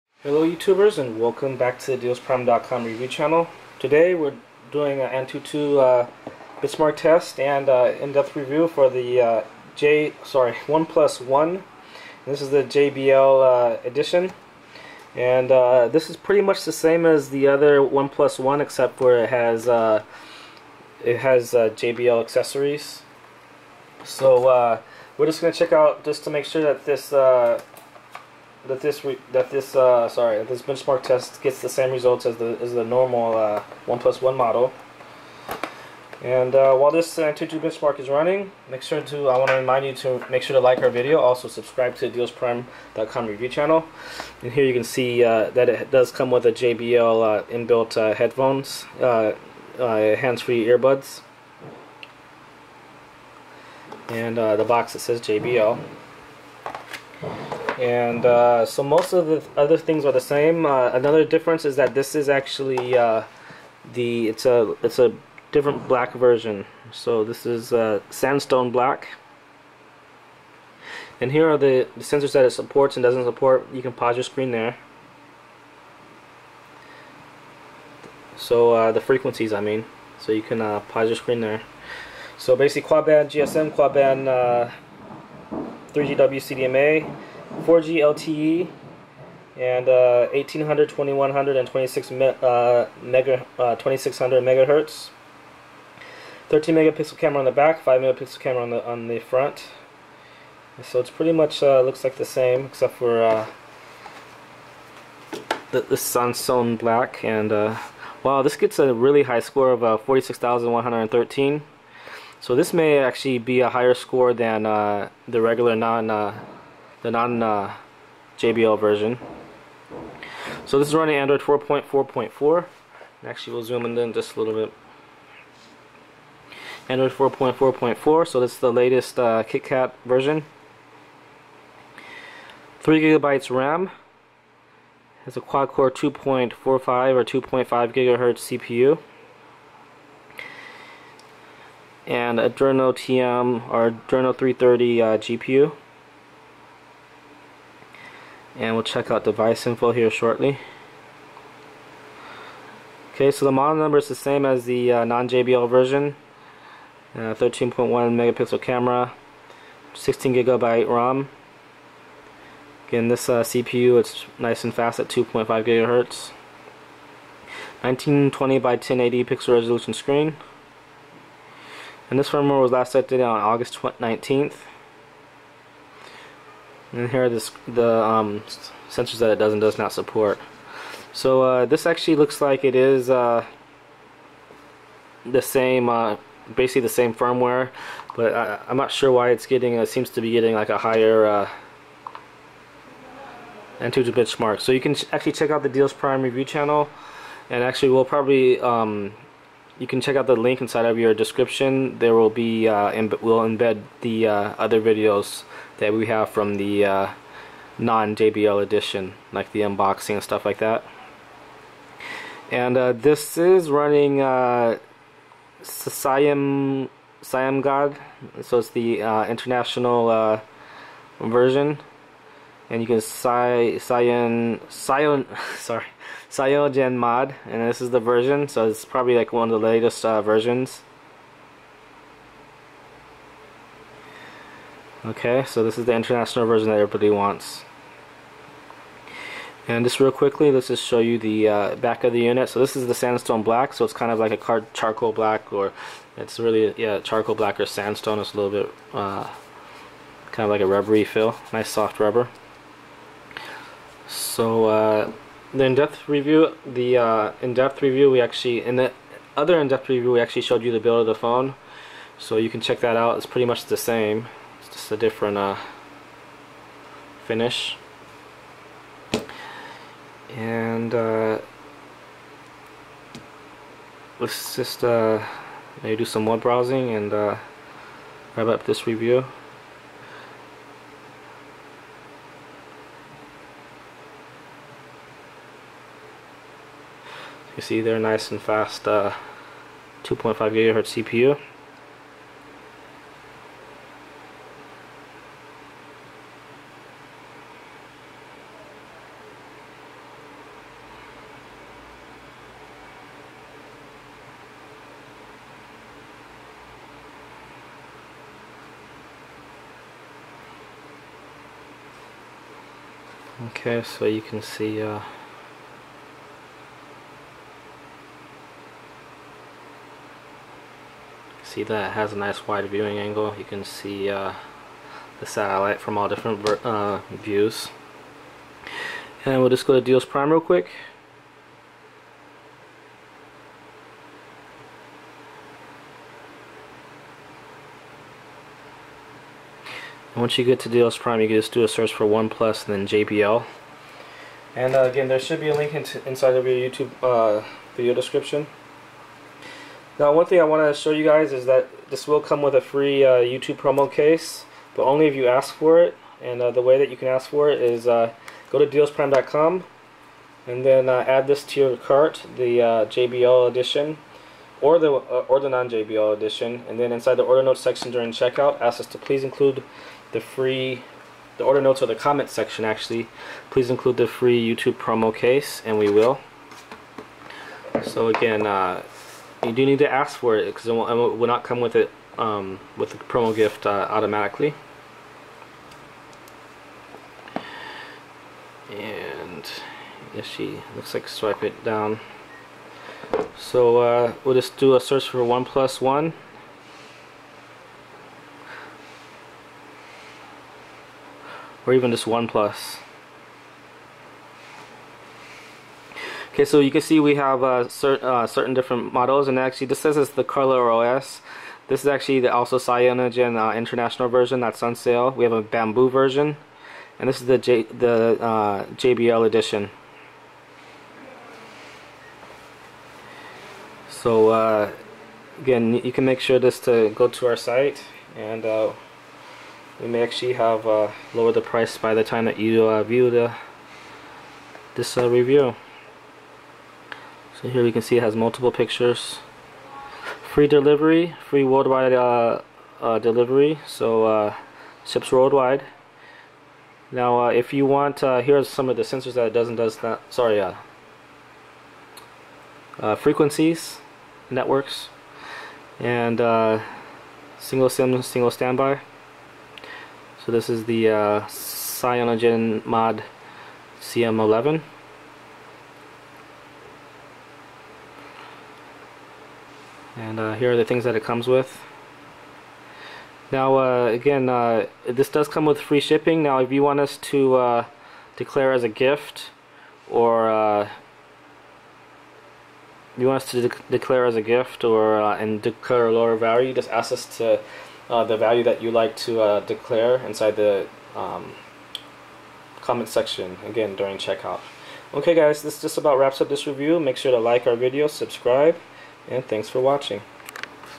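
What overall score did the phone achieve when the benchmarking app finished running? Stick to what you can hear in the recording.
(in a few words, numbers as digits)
46,113.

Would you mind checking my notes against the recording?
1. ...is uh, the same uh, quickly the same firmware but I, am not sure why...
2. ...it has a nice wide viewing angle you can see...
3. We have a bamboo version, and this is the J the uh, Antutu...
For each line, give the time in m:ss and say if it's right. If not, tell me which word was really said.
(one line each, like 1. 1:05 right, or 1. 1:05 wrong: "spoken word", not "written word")
1. 3:02 wrong: "basically", not "quickly"
2. 5:21 right
3. 6:55 wrong: "JBL", not "Antutu".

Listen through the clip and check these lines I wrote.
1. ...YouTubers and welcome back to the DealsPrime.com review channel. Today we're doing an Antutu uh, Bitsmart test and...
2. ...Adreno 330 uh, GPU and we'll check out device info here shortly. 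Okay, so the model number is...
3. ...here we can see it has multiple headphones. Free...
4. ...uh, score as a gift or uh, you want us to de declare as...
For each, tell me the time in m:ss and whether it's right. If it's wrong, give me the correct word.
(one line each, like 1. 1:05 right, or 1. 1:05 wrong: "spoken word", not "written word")
1. 0:00 right
2. 2:23 right
3. 7:17 wrong: "pictures", not "headphones"
4. 7:57 wrong: "declare", not "score".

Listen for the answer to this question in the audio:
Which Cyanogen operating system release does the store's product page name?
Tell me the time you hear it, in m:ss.
7:43.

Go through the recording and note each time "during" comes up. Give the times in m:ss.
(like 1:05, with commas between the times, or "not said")
6:07, 8:13.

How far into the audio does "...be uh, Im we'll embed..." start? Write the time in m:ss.
3:22.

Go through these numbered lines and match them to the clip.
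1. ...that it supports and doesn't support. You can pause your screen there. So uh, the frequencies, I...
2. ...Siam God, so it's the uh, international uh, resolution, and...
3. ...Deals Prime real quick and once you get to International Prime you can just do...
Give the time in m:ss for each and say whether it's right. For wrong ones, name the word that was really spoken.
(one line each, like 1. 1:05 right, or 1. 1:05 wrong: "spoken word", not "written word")
1. 1:12 right
2. 3:35 wrong: "version", not "resolution"
3. 5:29 wrong: "Deals", not "International".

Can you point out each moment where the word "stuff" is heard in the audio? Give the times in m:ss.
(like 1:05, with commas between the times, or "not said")
3:30.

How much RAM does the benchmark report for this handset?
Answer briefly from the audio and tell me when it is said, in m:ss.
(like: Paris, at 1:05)
3 gigabytes, at 2:12.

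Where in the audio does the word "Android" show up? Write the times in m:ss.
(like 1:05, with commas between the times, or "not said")
2:01, 2:06.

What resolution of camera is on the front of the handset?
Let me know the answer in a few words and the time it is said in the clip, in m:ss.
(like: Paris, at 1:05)
5 megapixel, at 1:37.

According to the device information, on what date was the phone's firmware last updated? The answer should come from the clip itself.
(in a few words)
August 19th.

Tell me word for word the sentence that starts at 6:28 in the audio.
And if she looks like swipe it down.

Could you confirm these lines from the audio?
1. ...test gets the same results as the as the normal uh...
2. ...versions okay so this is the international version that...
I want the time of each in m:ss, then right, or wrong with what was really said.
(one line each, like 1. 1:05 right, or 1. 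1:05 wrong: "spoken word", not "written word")
1. 0:31 right
2. 3:50 right.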